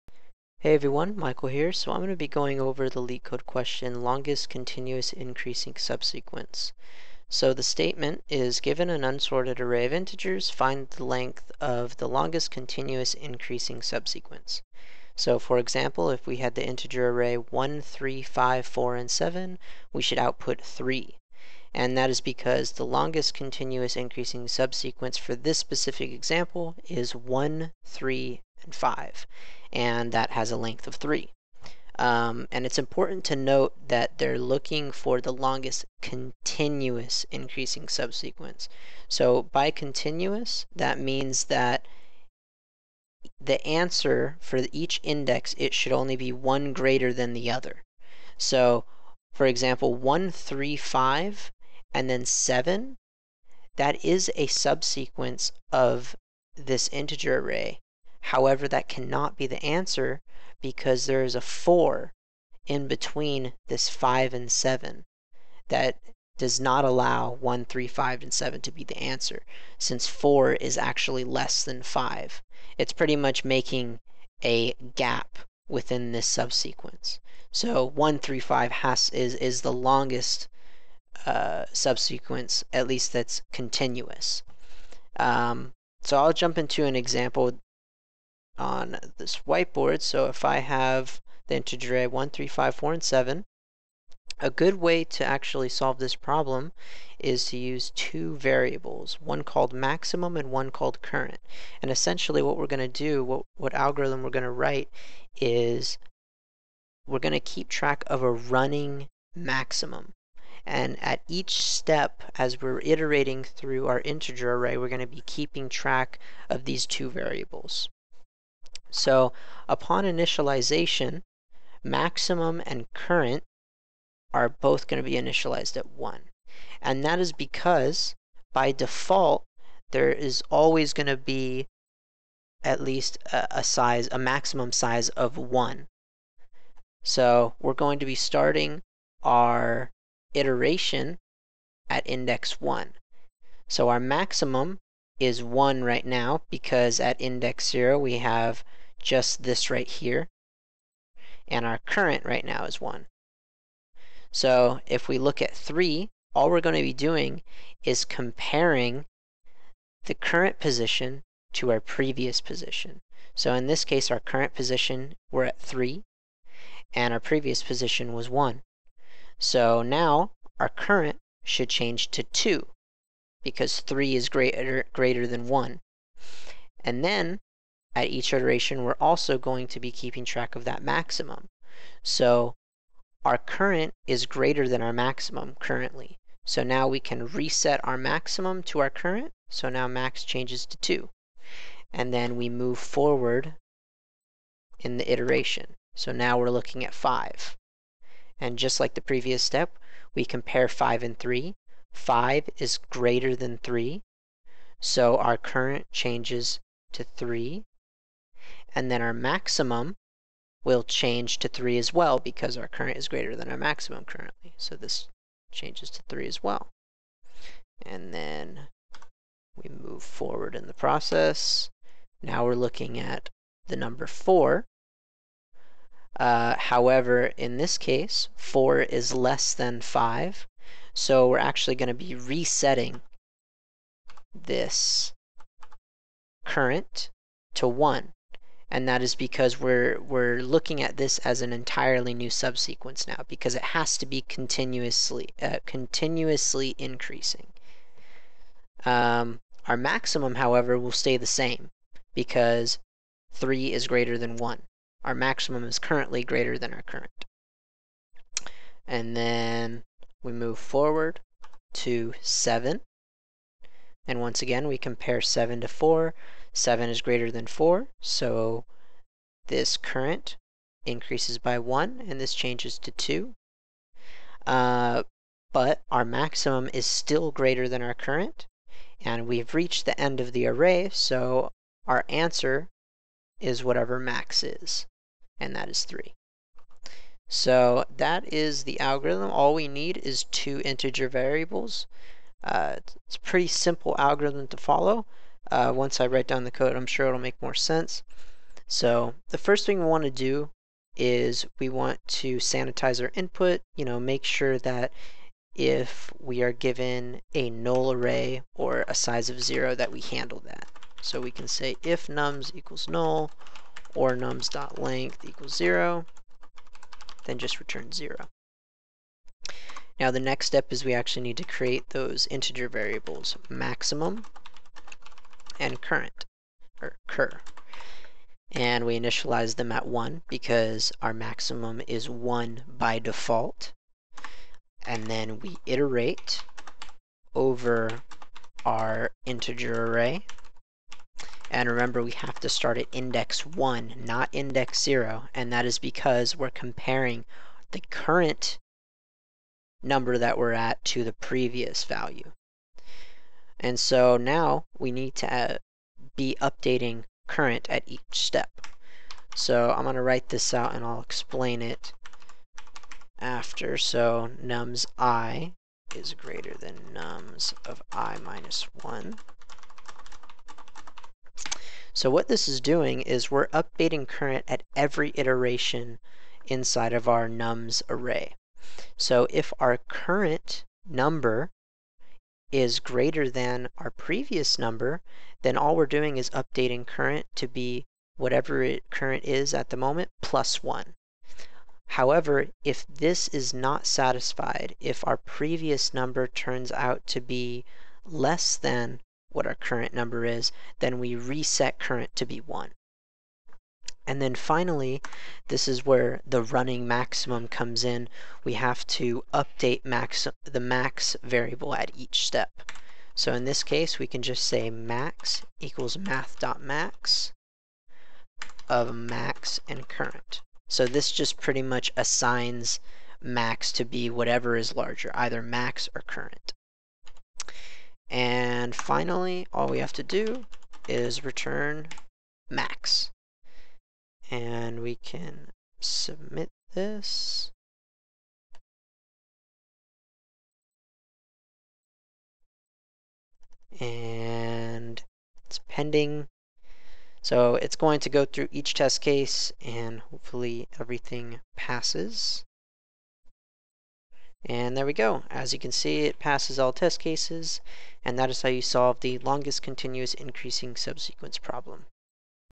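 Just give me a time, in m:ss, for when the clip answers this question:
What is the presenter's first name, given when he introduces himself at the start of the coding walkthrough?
0:01.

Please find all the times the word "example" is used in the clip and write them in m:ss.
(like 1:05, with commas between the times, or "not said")
0:15, 0:26, 0:49, 1:26.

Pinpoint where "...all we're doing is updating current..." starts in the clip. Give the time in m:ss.
6:25.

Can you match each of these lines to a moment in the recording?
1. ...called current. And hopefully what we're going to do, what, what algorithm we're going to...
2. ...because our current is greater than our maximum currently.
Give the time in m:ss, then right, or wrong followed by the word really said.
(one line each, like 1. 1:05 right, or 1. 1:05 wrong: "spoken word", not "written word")
1. 1:40 wrong: "essentially", not "hopefully"
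2. 3:32 right.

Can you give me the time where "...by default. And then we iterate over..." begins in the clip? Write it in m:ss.
5:32.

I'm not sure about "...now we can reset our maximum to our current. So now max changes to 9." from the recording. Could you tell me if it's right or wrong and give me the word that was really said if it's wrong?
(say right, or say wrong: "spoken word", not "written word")
wrong: "2", not "9".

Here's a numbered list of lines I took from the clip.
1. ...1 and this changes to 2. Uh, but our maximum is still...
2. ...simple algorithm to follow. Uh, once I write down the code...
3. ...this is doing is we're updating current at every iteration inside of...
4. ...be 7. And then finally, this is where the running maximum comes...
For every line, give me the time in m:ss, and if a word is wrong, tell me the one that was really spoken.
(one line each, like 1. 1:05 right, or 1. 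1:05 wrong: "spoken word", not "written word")
1. 4:31 right
2. 4:53 right
3. 6:12 right
4. 6:42 wrong: "1", not "7".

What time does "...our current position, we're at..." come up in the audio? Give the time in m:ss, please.
2:44.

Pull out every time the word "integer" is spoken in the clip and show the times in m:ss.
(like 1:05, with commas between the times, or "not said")
0:09, 0:16, 0:56, 1:31, 1:54, 4:50, 5:22, 5:39.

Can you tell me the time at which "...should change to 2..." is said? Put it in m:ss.
2:51.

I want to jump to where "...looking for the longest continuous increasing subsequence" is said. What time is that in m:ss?
0:34.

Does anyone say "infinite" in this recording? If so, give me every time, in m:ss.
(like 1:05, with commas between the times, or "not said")
not said.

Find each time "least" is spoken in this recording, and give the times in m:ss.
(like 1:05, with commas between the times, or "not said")
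1:22, 2:12.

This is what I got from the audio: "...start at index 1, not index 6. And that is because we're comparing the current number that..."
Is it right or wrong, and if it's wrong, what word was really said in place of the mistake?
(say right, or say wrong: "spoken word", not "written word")
wrong: "0", not "6".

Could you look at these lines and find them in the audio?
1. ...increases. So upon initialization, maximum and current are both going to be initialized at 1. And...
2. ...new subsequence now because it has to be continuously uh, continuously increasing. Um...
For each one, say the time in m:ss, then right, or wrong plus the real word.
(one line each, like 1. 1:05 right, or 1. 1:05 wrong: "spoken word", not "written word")
1. 1:57 wrong: "variables", not "increases"
2. 4:02 right.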